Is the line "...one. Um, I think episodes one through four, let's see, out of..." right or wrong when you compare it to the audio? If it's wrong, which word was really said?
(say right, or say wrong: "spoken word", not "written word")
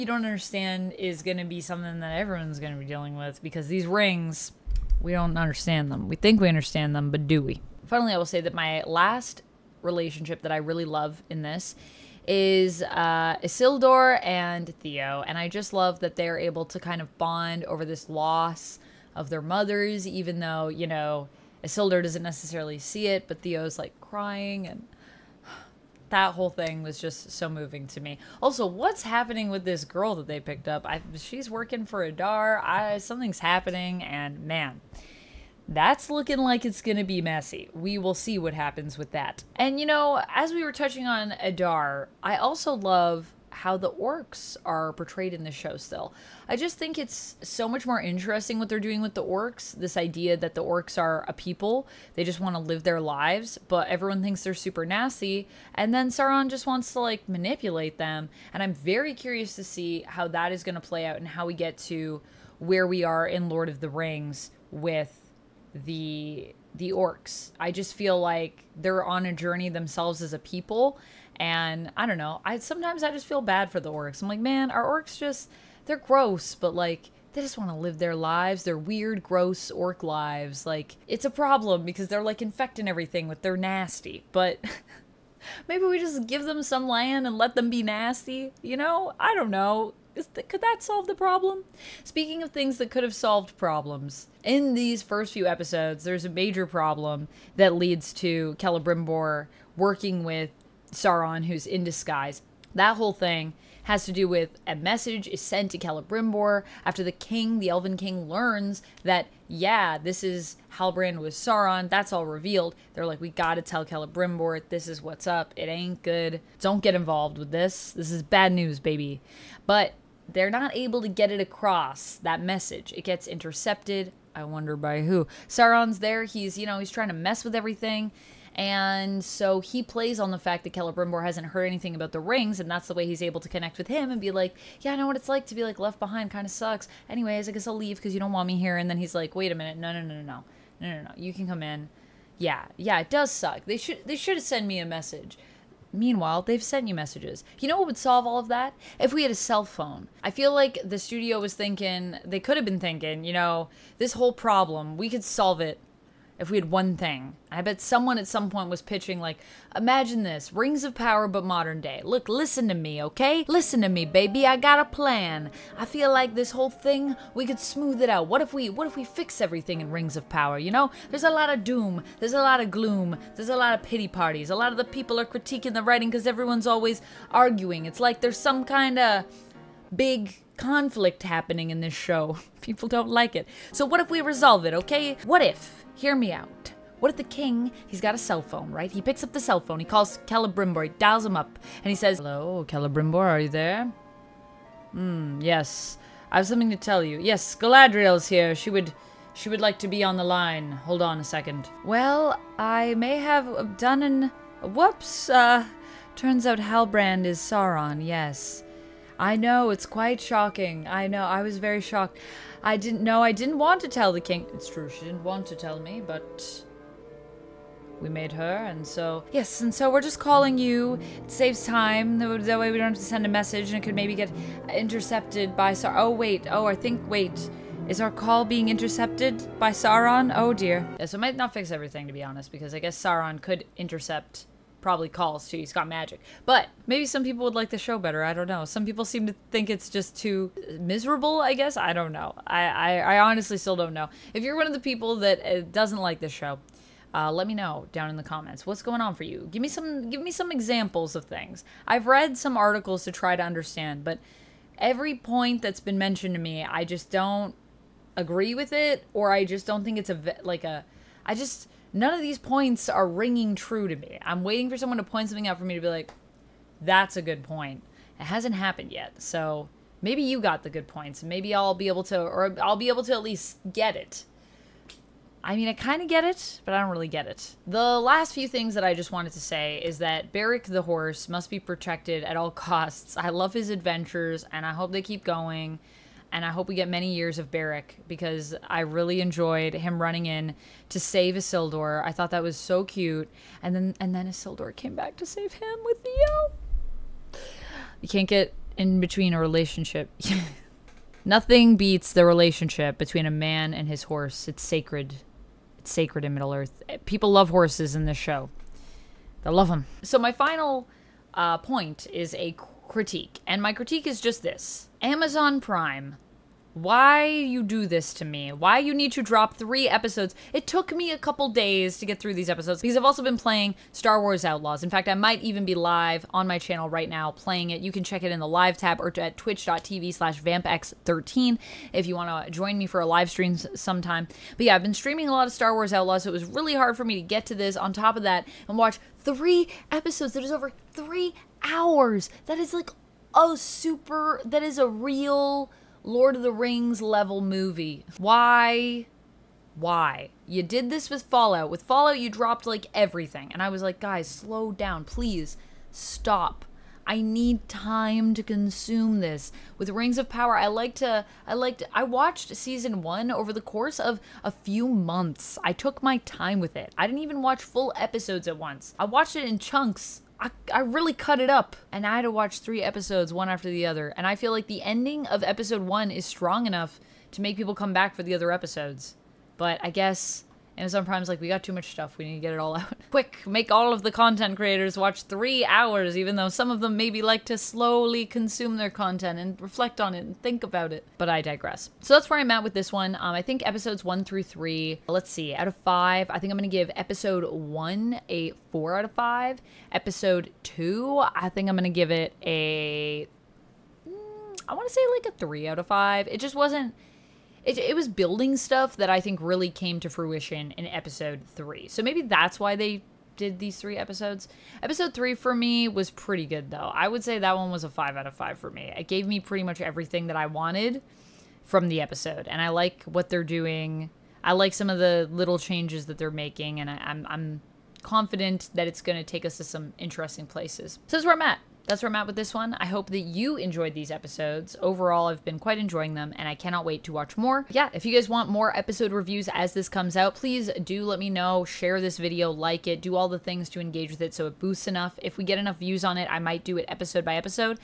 wrong: "three", not "four".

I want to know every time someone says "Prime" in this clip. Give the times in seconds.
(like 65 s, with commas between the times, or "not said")
315 s, 381 s.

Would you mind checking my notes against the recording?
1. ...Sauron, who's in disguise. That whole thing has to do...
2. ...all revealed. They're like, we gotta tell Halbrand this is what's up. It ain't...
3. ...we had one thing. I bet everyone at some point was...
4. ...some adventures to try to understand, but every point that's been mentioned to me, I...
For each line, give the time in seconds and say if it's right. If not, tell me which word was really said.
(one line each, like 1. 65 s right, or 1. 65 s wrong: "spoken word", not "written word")
1. 100 s right
2. 112 s wrong: "Celebrimbor", not "Halbrand"
3. 156 s wrong: "someone", not "everyone"
4. 252 s wrong: "articles", not "adventures".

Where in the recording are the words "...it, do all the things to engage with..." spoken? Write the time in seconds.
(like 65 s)
442 s.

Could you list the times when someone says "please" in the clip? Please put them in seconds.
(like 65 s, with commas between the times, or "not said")
355 s, 440 s.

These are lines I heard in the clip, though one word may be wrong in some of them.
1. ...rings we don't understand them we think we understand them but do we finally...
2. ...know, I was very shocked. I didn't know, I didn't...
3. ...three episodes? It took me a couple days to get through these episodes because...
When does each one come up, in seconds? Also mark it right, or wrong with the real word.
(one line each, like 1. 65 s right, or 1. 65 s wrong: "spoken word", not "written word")
1. 3 s right
2. 211 s right
3. 319 s right.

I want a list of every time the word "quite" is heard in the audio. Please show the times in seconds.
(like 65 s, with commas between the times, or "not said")
209 s, 435 s.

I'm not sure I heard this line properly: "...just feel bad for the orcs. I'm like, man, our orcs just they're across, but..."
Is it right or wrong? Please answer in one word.
wrong.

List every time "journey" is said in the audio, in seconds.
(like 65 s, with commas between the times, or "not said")
69 s.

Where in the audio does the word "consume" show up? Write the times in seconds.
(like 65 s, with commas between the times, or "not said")
358 s, 388 s.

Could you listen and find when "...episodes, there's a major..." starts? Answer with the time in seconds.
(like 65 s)
95 s.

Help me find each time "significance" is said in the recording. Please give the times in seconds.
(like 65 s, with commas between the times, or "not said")
not said.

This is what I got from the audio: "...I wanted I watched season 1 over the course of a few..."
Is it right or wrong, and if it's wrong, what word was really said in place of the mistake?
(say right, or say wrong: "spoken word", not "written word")
wrong: "liked", not "wanted".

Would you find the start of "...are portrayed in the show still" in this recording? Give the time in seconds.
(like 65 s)
44 s.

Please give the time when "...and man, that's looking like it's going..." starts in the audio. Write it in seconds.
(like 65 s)
34 s.